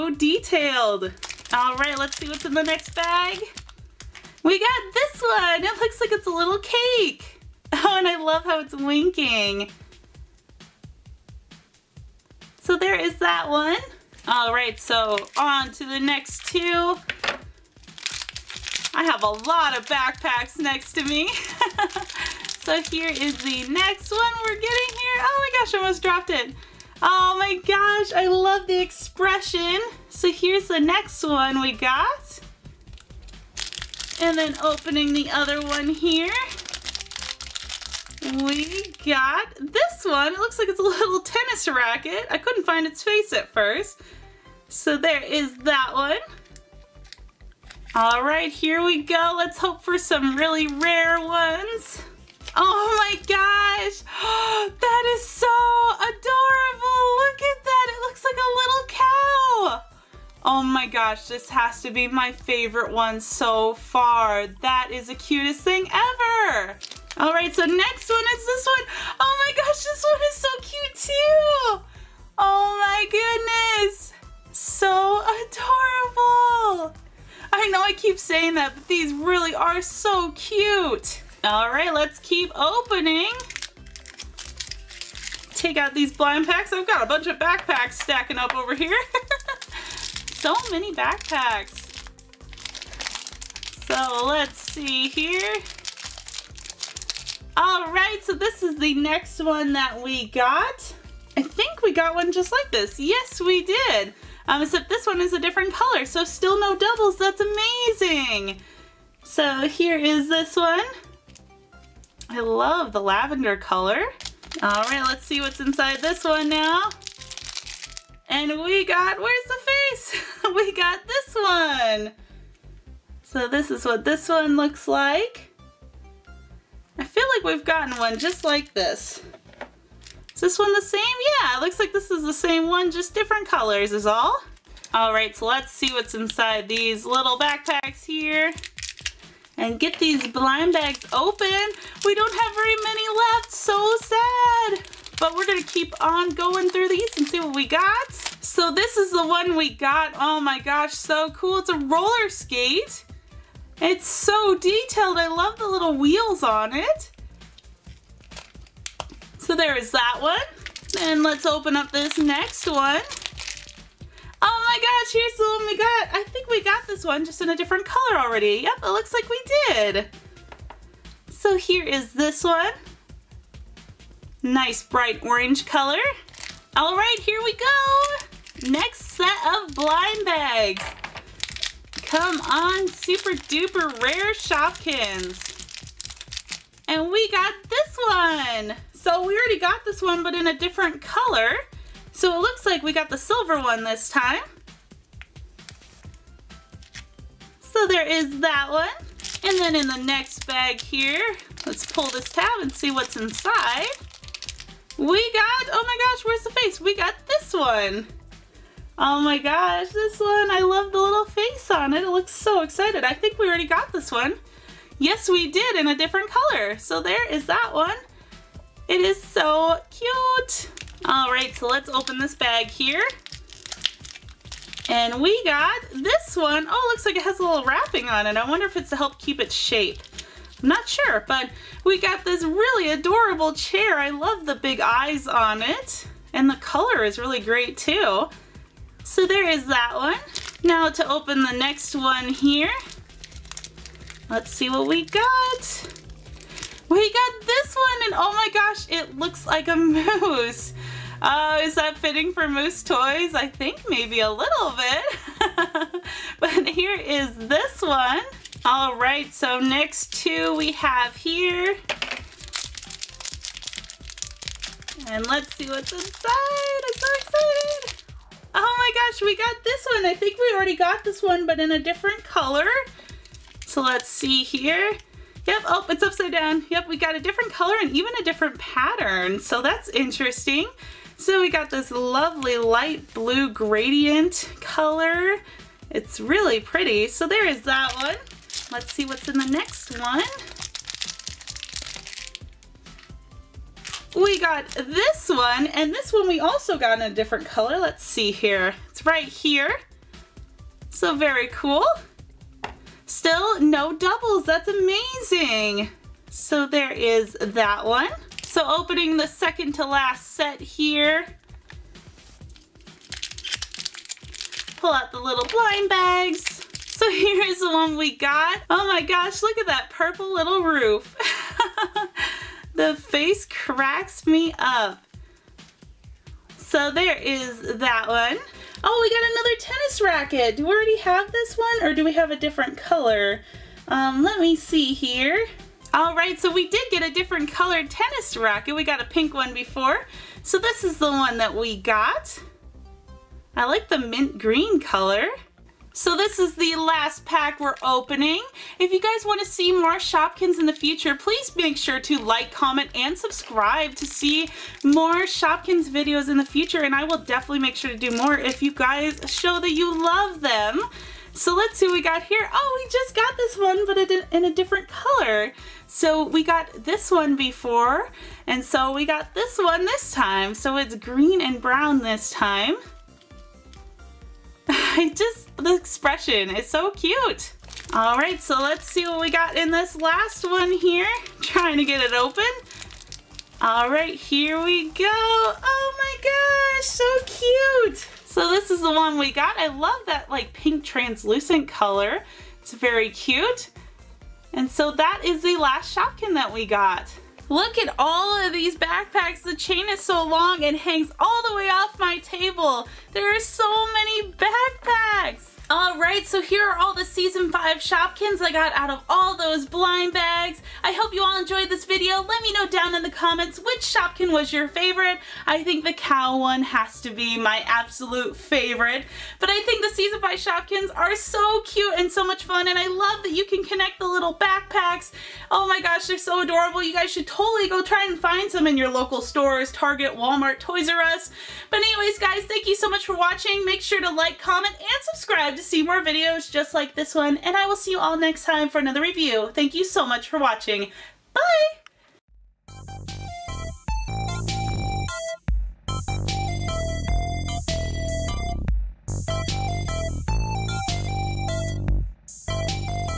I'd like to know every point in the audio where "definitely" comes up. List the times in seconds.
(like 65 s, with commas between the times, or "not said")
357 s.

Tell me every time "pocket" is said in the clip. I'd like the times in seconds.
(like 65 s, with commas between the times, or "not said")
not said.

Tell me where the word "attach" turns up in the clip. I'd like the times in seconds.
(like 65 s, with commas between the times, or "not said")
not said.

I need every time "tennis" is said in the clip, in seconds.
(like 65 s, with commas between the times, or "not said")
41 s, 329 s, 337 s.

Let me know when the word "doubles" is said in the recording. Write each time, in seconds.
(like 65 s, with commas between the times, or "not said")
106 s, 303 s.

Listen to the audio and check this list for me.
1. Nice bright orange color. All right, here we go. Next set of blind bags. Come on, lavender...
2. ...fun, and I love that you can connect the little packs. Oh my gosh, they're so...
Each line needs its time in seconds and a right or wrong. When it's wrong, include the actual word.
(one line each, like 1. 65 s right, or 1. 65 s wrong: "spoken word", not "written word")
1. 174 s wrong: "super", not "lavender"
2. 422 s wrong: "backpacks", not "packs".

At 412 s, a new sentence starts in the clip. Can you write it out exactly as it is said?
Let me know down in the comments which Shopkin was your favorite.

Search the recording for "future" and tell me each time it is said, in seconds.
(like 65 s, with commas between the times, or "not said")
350 s, 356 s.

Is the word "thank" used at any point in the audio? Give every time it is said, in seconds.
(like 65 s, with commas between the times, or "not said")
432 s, 439 s.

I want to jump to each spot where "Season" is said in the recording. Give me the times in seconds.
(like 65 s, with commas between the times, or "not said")
407 s, 419 s.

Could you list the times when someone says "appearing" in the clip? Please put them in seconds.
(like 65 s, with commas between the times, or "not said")
not said.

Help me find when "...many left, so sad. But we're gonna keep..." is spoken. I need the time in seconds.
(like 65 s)
142 s.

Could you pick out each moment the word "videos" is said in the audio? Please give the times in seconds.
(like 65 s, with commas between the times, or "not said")
355 s, 411 s, 436 s.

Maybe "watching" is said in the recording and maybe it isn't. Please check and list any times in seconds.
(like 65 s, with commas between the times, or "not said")
433 s, 440 s.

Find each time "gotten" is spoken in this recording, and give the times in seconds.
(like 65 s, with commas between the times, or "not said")
127 s.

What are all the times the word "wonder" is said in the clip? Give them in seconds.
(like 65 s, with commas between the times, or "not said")
228 s.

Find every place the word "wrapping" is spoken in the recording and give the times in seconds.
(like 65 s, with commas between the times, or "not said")
227 s.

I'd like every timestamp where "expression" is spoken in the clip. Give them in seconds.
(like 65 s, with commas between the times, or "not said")
28 s, 375 s.